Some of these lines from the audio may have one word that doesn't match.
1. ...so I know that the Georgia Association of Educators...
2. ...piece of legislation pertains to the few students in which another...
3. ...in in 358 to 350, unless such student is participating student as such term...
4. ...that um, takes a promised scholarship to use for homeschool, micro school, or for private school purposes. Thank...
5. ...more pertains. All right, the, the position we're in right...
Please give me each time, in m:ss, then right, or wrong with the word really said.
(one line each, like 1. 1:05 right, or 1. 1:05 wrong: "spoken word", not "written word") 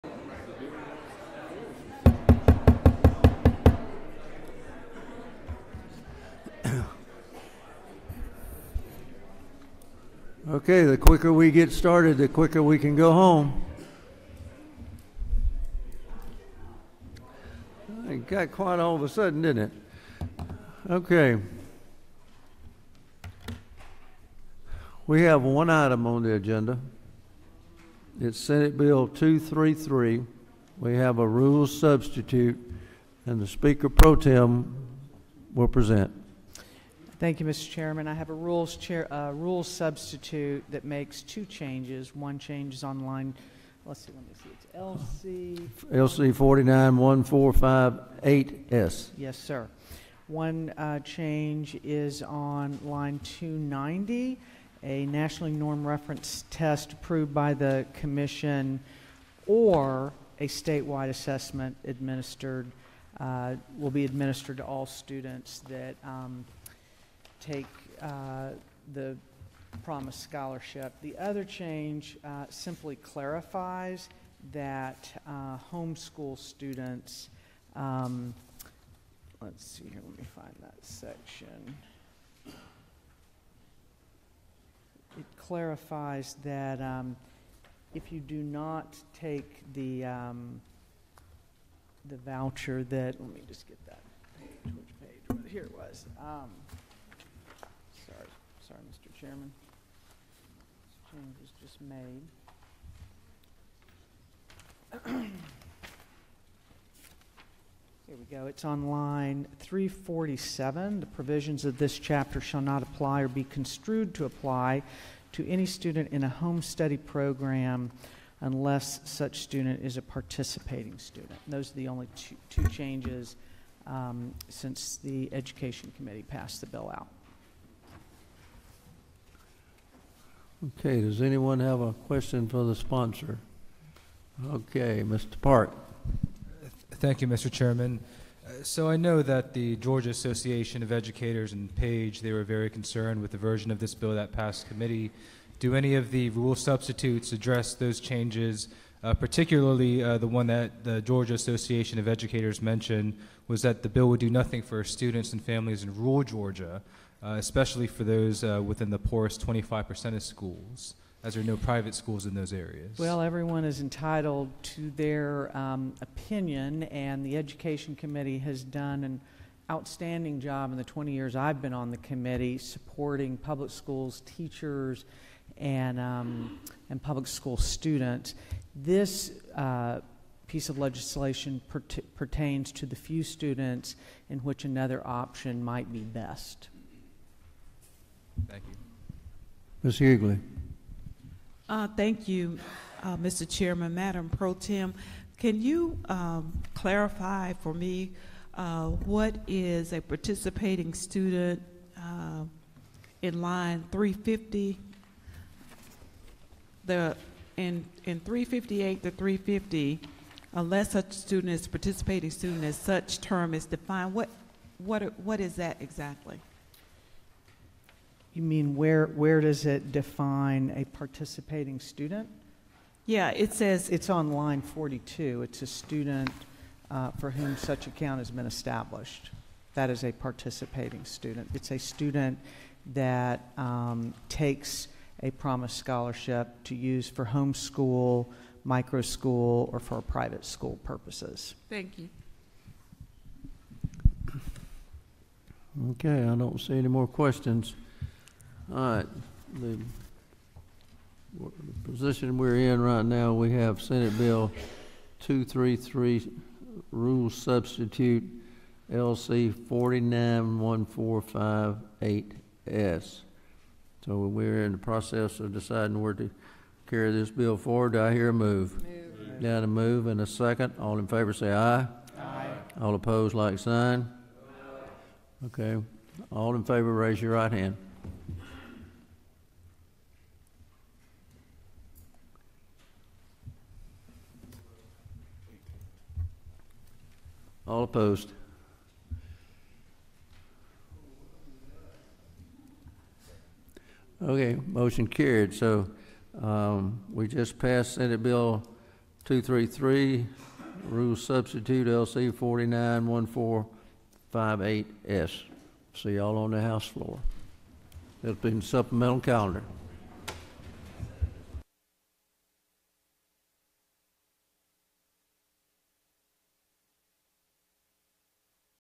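1. 2:18 right
2. 3:00 right
3. 3:27 right
4. 3:52 right
5. 4:06 wrong: "questions", not "pertains".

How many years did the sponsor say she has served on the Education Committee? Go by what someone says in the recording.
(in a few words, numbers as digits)
20.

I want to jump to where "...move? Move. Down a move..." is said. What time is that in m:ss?
4:28.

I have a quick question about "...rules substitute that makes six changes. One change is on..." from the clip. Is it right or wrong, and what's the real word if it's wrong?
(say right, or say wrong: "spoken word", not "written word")
wrong: "two", not "six".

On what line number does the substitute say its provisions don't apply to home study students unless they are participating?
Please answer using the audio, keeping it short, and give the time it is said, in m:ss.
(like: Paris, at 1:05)
347, at 1:49.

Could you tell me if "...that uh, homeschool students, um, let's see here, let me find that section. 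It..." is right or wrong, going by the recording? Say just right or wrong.
right.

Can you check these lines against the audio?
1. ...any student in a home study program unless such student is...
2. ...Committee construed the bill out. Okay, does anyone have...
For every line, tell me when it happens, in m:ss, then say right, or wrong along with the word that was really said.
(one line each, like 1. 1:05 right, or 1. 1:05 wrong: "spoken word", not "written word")
1. 1:55 right
2. 2:05 wrong: "passed", not "construed".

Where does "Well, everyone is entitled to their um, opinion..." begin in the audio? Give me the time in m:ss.
2:42.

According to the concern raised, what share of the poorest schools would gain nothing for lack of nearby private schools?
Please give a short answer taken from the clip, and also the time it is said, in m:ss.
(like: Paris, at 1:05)
25%, at 2:39.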